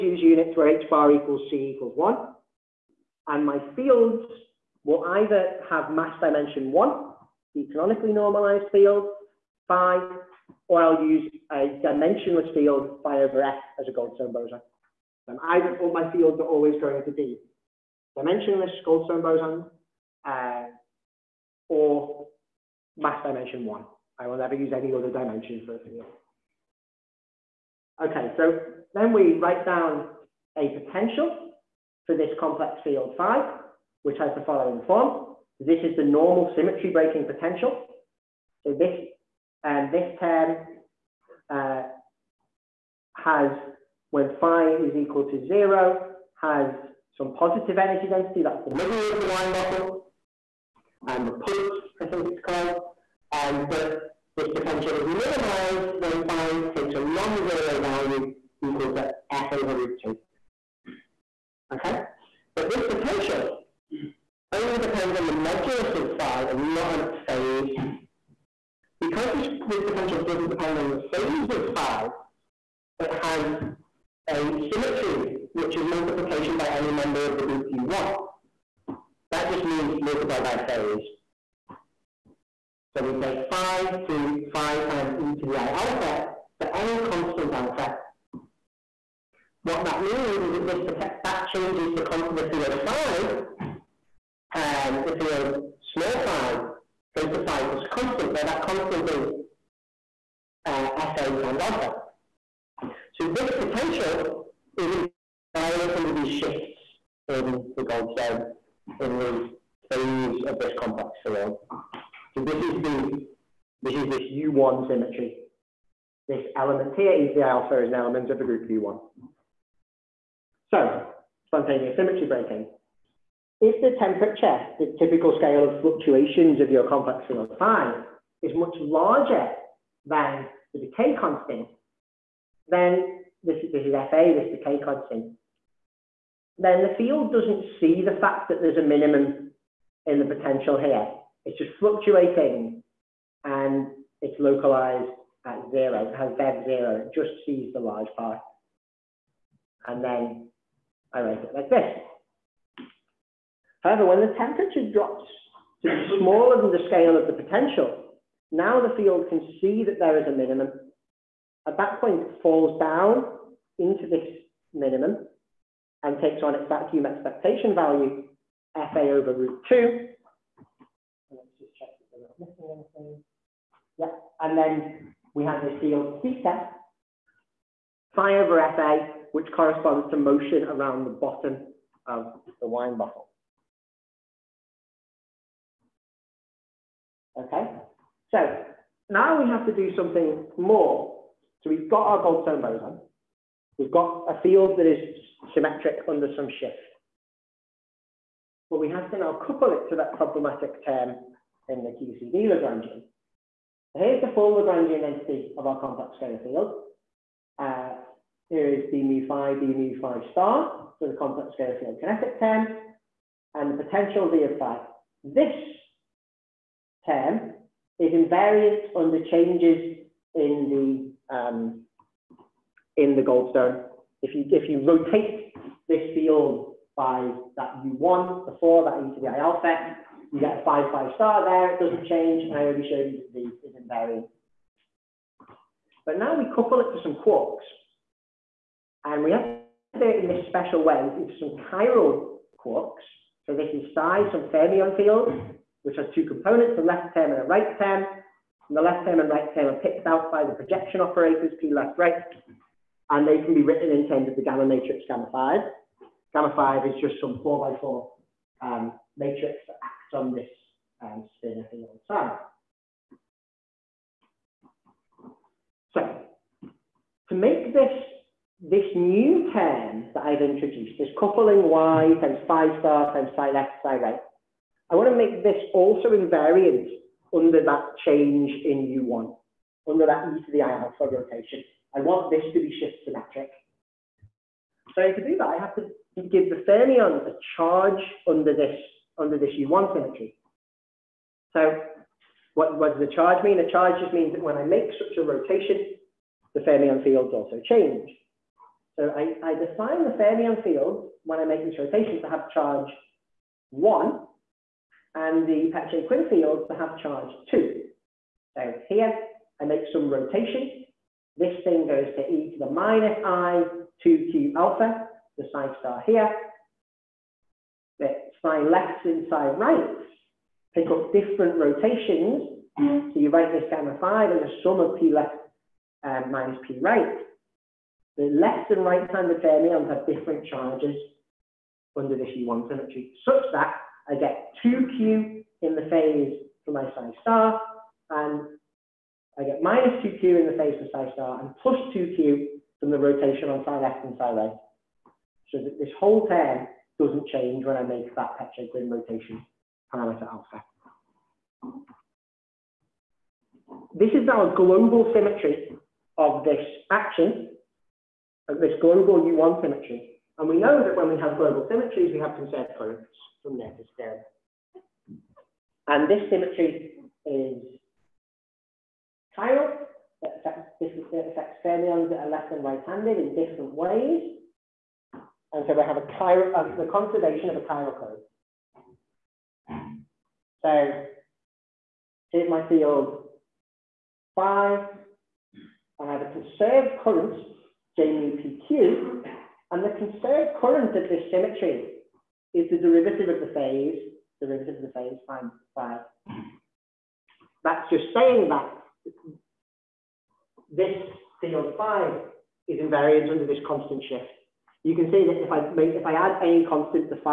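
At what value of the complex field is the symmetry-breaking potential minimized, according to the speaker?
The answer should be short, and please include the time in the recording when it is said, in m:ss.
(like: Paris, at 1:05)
f over root 2, at 0:59.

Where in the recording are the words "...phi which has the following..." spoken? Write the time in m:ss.
0:33.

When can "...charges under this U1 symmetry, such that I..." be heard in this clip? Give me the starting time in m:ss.
5:30.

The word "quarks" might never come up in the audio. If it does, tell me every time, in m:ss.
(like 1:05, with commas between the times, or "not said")
3:57, 4:02.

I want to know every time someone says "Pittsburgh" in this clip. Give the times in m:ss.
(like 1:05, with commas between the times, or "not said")
not said.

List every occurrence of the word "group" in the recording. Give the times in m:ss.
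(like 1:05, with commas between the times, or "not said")
1:17, 1:58.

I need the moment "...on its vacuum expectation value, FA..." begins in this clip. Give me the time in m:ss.
2:46.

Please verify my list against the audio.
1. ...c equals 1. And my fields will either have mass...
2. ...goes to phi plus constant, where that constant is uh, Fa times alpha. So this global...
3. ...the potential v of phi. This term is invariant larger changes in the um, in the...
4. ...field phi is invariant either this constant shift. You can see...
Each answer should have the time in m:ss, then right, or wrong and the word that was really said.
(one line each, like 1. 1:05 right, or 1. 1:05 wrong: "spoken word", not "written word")
1. 0:01 right
2. 1:37 wrong: "potential", not "global"
3. 3:33 wrong: "under", not "larger"
4. 6:41 wrong: "under", not "either".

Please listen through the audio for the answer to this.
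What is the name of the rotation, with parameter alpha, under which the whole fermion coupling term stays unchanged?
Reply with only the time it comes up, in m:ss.
5:48.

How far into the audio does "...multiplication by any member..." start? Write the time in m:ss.
1:15.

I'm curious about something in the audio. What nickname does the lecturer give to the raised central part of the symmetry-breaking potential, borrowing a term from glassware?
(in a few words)
the punt.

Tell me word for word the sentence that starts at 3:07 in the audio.
Okay, so now we have to do something more.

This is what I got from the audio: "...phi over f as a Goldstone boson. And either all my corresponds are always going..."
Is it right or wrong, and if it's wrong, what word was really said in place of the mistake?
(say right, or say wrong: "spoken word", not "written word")
wrong: "fields", not "corresponds".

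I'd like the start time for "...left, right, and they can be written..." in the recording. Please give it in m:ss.
4:11.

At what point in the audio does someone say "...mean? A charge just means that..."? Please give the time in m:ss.
4:53.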